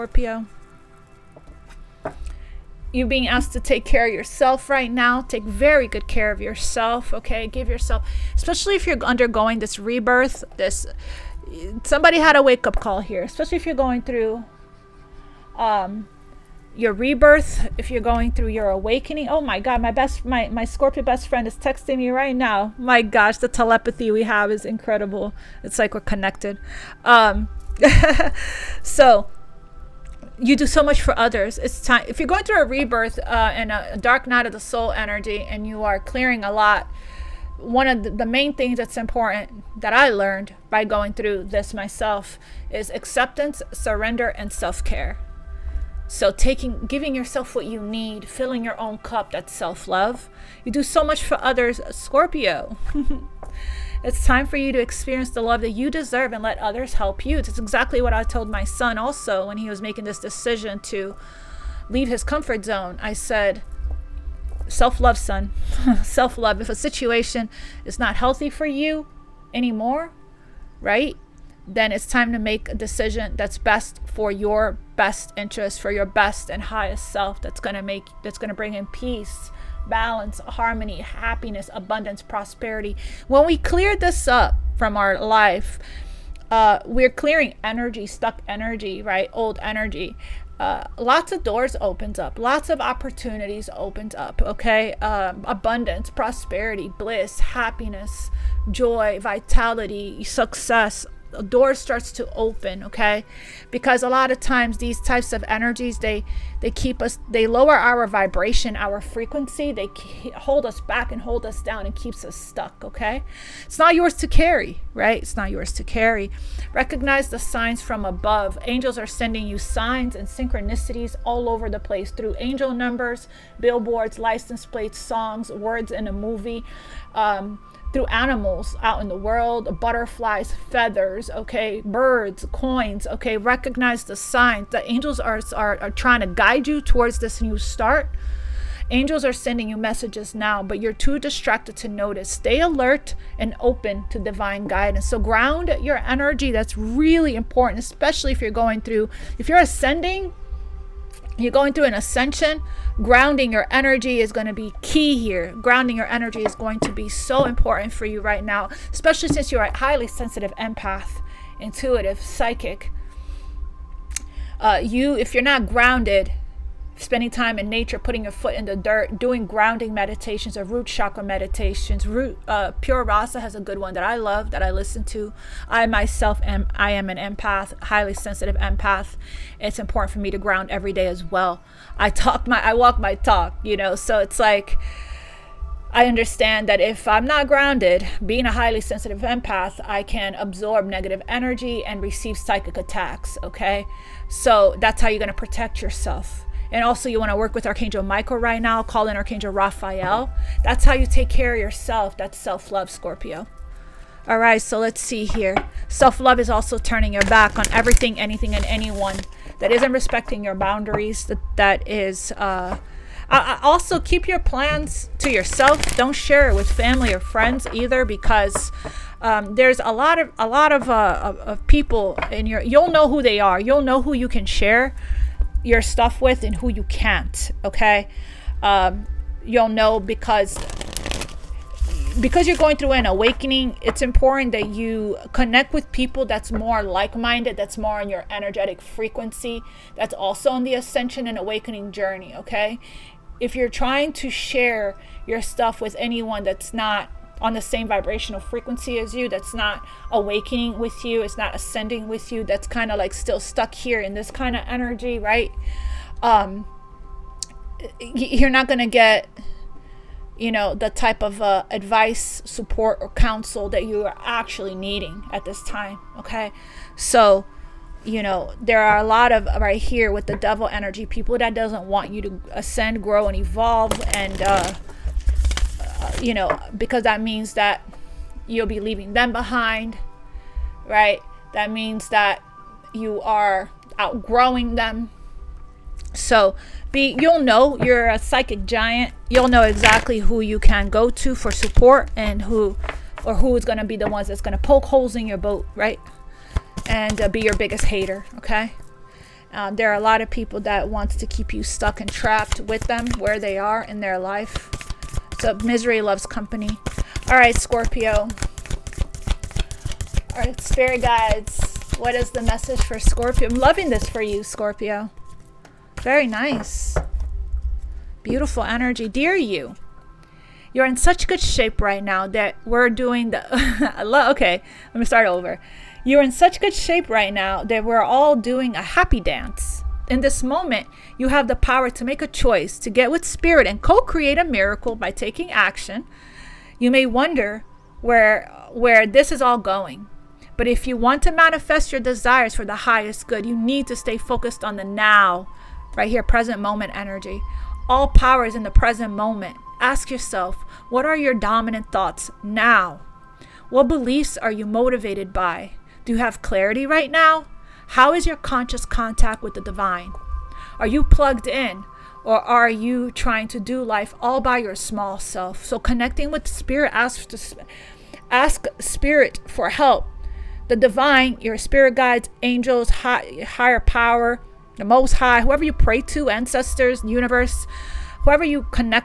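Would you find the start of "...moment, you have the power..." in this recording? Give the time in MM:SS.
05:30.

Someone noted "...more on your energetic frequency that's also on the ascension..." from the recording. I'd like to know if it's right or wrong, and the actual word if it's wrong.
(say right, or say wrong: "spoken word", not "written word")
right.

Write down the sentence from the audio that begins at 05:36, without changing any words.
You may wonder where where this is all going.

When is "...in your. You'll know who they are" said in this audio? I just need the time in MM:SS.
03:42.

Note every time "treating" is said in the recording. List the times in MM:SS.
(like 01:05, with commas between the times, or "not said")
not said.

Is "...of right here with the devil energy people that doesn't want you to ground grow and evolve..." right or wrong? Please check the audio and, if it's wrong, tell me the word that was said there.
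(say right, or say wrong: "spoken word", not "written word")
wrong: "ascend", not "ground".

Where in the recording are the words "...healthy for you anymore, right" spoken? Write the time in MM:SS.
01:08.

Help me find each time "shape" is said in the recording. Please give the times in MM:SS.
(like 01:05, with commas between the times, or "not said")
05:21, 05:26.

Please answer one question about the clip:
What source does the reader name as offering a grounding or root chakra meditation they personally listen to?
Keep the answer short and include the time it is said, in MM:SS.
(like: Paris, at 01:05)
Pure Rasa, at 02:52.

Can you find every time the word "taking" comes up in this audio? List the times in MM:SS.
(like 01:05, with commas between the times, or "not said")
00:46, 05:35.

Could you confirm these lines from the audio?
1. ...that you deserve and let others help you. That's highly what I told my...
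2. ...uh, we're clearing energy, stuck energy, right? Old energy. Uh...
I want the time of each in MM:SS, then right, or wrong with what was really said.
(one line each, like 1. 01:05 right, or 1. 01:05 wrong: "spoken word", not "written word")
1. 00:55 wrong: "exactly", not "highly"
2. 01:26 right.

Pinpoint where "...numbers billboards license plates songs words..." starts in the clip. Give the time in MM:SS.
02:02.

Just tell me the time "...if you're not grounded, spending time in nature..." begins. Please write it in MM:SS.
02:45.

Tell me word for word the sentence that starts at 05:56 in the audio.
Do you have clarity right now?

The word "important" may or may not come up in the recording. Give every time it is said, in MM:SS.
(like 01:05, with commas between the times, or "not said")
00:38, 02:27, 02:37, 02:59, 03:54.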